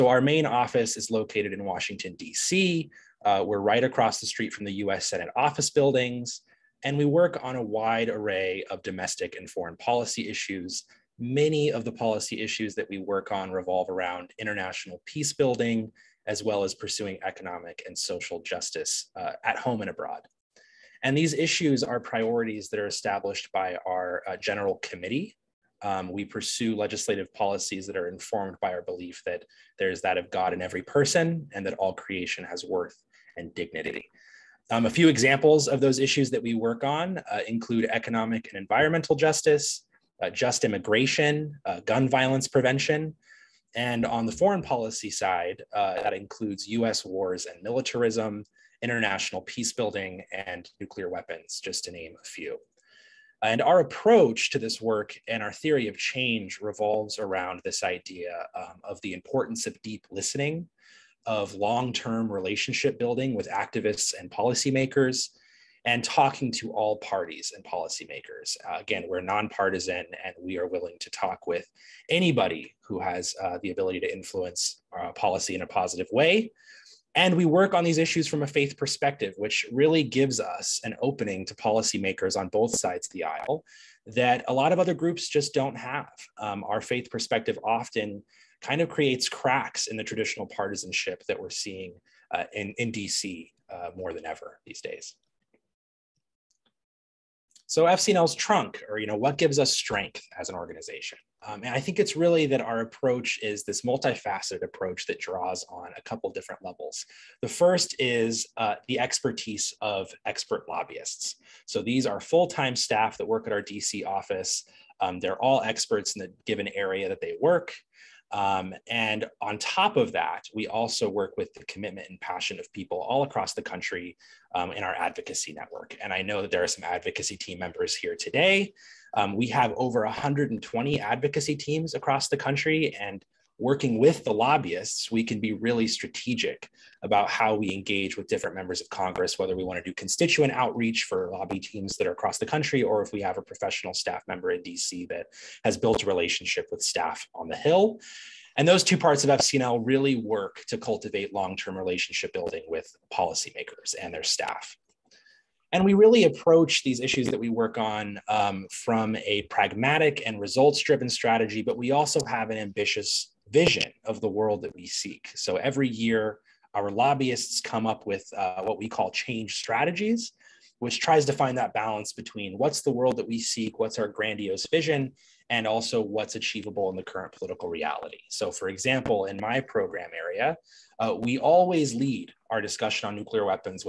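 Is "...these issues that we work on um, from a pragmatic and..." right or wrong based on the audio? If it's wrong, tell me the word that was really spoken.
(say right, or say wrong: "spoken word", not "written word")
right.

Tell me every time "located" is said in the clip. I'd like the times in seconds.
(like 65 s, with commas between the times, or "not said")
1 s.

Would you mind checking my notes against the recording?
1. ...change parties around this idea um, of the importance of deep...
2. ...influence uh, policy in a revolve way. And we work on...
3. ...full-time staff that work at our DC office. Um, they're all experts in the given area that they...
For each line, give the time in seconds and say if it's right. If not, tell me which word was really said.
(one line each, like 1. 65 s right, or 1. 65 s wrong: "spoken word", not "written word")
1. 55 s wrong: "revolves", not "parties"
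2. 74 s wrong: "positive", not "revolve"
3. 112 s right.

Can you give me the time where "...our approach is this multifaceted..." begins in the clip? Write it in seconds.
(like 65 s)
102 s.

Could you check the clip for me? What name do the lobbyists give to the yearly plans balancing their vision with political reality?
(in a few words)
change strategies.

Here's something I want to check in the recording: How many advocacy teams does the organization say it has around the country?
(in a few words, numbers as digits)
over 120.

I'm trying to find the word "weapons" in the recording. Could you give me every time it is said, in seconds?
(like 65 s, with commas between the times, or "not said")
51 s.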